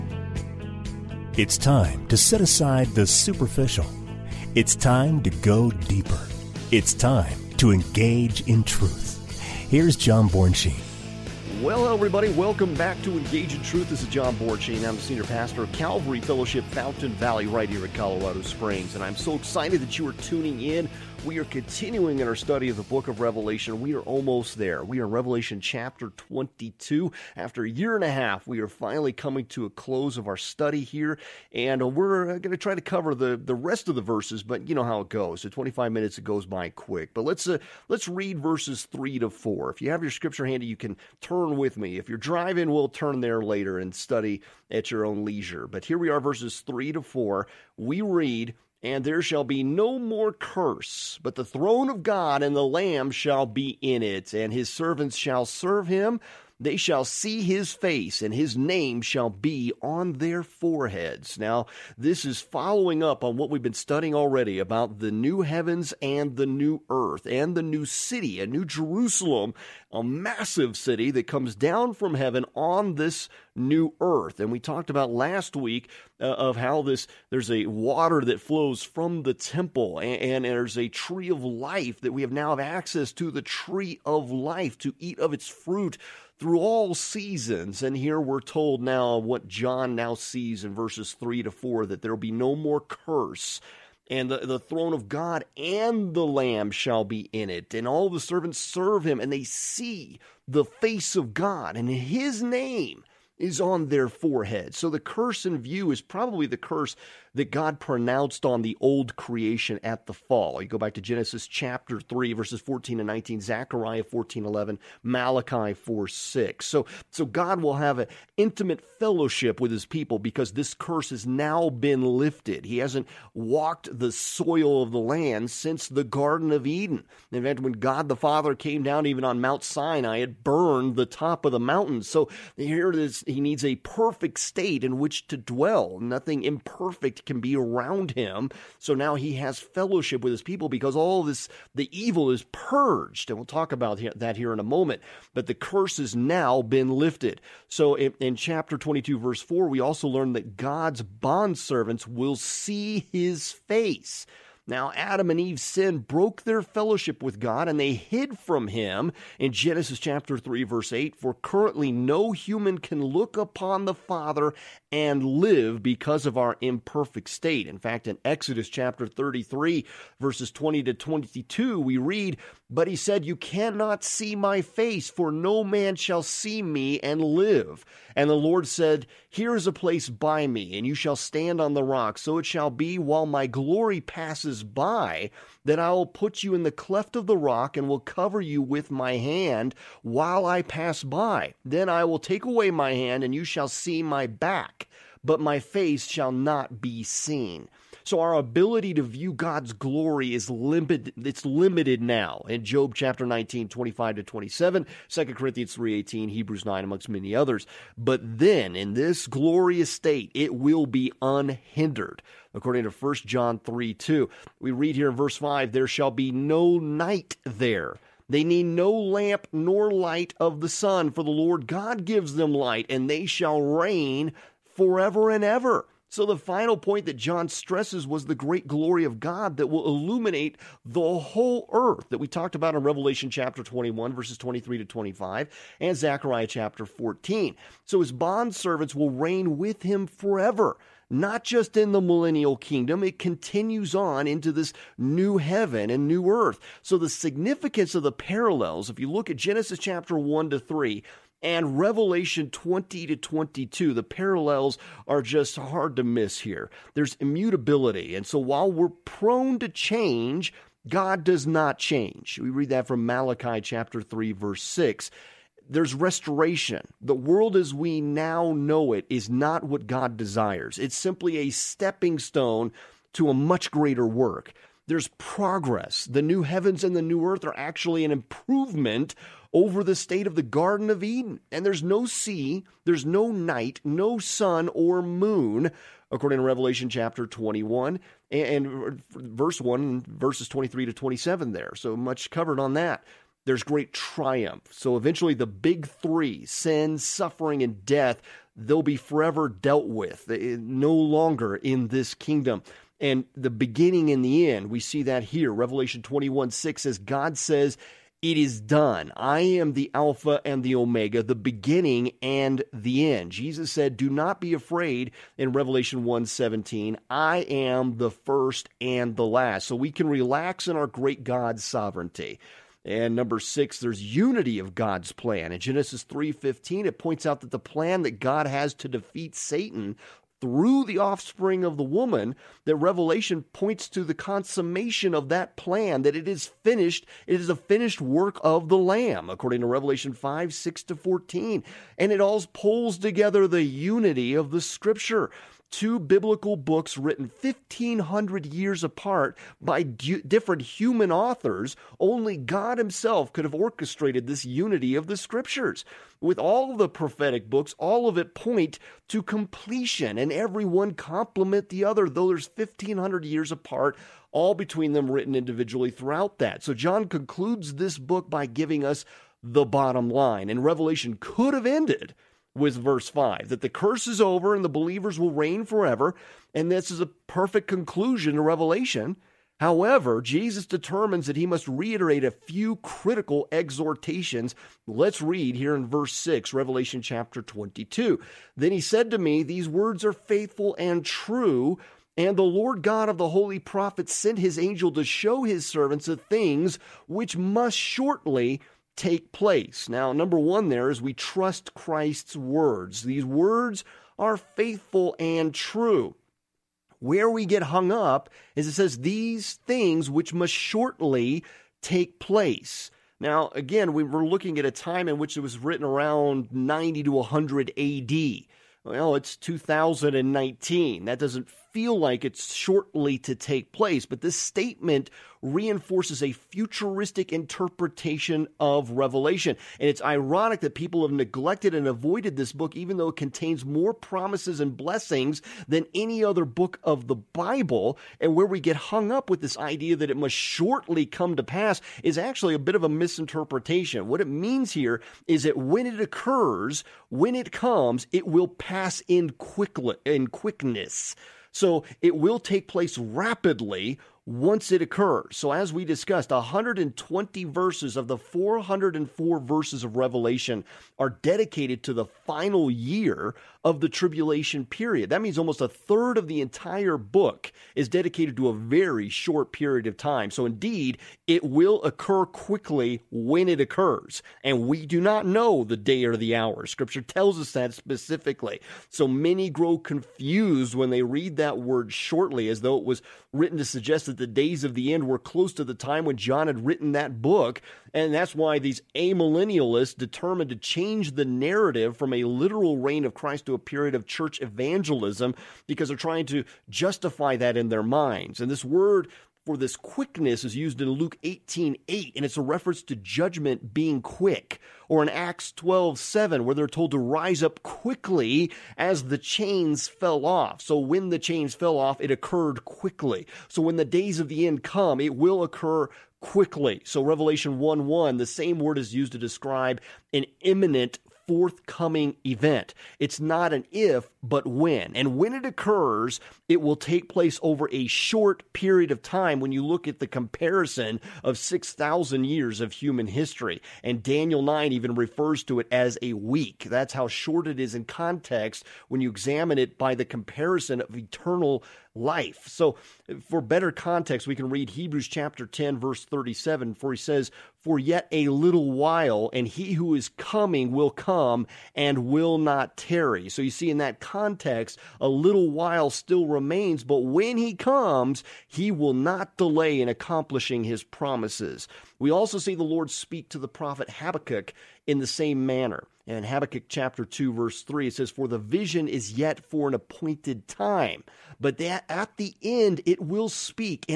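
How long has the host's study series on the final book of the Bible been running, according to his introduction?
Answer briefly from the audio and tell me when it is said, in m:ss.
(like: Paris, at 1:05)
a year and a half, at 0:27.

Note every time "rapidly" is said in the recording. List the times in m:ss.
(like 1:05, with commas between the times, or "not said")
7:32.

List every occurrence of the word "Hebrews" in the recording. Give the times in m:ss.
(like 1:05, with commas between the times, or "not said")
3:26, 9:04.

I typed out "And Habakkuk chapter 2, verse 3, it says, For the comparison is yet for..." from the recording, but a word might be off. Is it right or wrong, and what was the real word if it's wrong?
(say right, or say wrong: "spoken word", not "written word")
wrong: "vision", not "comparison".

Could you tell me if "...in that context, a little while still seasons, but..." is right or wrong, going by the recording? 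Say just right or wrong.
wrong.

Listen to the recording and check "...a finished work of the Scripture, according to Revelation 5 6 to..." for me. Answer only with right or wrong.
wrong.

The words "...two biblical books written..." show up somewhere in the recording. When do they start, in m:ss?
5:45.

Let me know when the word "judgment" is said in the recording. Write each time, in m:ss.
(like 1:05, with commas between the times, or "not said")
8:22.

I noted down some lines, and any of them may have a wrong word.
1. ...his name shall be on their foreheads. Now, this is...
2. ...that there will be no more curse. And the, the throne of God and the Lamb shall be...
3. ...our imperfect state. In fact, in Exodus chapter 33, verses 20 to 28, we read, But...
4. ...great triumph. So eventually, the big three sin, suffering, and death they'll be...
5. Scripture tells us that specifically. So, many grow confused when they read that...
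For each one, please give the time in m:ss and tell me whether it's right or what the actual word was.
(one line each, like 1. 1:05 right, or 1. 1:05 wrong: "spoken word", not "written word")
1. 0:58 right
2. 1:31 right
3. 2:46 wrong: "22", not "28"
4. 4:53 right
5. 7:56 right.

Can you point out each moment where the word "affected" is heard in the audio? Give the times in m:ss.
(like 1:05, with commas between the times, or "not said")
not said.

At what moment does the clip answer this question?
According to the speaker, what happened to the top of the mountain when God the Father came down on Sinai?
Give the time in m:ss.
2:10.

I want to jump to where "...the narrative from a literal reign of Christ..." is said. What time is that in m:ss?
8:11.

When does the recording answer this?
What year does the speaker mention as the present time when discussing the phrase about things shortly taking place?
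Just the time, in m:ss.
6:59.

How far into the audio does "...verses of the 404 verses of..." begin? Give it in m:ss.
7:37.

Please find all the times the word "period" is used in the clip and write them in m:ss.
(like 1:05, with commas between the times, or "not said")
7:44, 7:49, 8:13, 8:48.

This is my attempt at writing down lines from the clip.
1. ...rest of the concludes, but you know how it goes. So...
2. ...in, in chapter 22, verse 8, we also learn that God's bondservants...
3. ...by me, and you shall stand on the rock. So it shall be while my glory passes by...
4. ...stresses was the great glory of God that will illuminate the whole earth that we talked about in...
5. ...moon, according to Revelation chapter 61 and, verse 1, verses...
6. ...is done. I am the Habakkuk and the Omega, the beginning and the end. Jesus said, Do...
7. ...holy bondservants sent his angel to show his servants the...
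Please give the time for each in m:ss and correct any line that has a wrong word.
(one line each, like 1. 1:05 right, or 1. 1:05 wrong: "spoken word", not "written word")
1. 0:33 wrong: "verses", not "concludes"
2. 2:27 wrong: "4", not "8"
3. 3:00 right
4. 3:47 right
5. 4:45 wrong: "21", not "61"
6. 5:08 wrong: "Alpha", not "Habakkuk"
7. 6:33 wrong: "prophets", not "bondservants".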